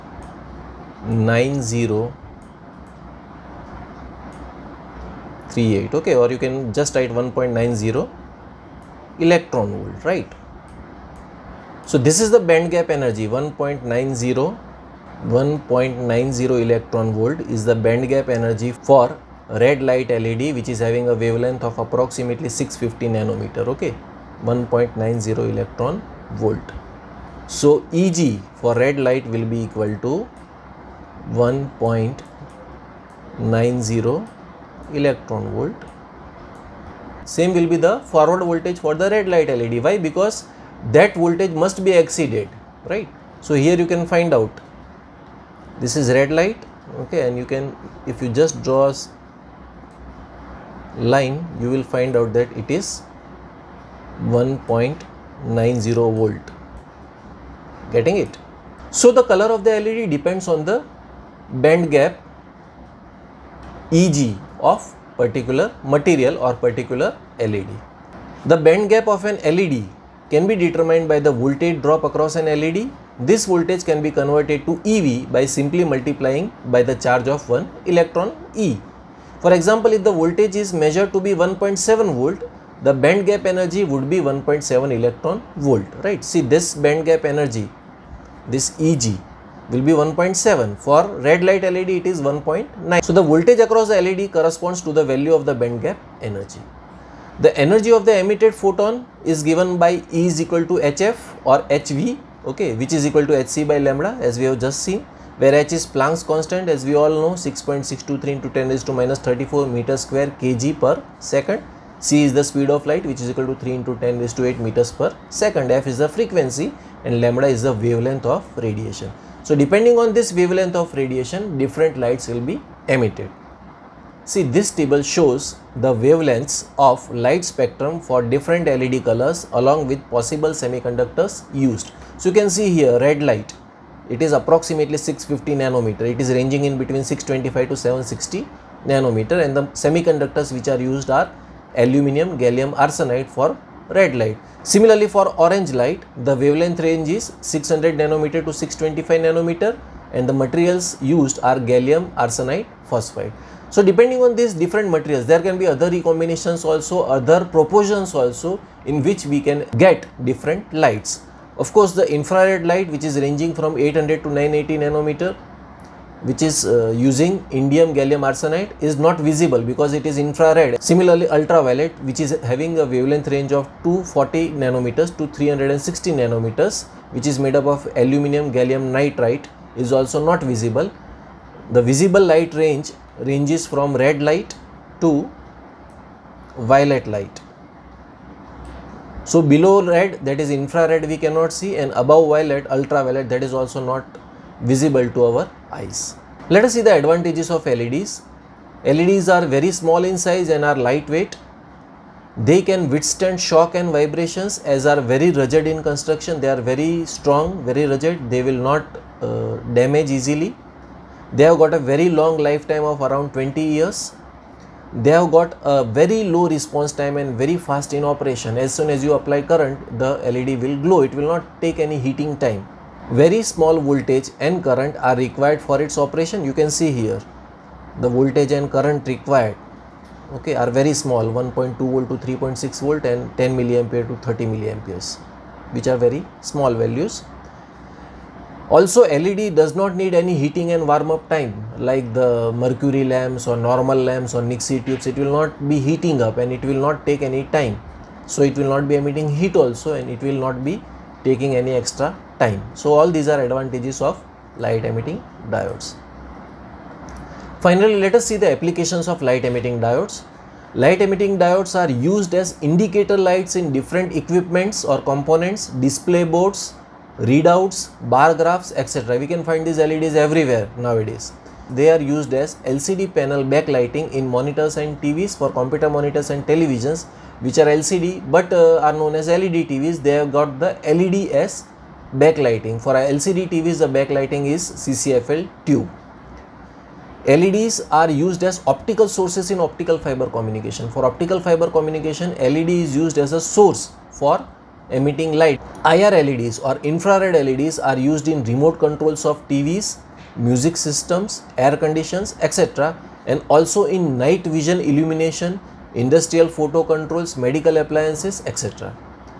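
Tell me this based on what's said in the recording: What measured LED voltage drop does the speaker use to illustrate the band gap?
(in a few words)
1.7 volt.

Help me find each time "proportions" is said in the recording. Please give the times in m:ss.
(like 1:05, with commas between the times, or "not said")
2:37.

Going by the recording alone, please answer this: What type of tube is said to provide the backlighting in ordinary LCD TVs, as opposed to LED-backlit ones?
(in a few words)
CCFL tube.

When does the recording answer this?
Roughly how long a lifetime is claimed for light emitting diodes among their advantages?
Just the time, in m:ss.
3:33.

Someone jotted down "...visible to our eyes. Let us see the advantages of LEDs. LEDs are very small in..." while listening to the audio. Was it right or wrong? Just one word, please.
right.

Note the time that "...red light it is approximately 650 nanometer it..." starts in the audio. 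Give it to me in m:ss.
2:12.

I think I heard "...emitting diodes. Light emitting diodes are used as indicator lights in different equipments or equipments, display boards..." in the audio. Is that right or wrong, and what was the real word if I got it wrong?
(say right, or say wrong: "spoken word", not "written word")
wrong: "components", not "equipments".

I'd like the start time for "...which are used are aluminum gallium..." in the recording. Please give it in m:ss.
2:20.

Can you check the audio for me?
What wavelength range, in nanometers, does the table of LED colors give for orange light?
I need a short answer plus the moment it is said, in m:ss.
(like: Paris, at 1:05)
600 to 625 nanometer, at 2:27.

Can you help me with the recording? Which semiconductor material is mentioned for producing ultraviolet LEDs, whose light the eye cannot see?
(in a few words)
aluminum gallium nitride.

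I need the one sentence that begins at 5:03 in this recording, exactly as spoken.
and also in night vision illumination, industrial photo controls, medical appliances, etc.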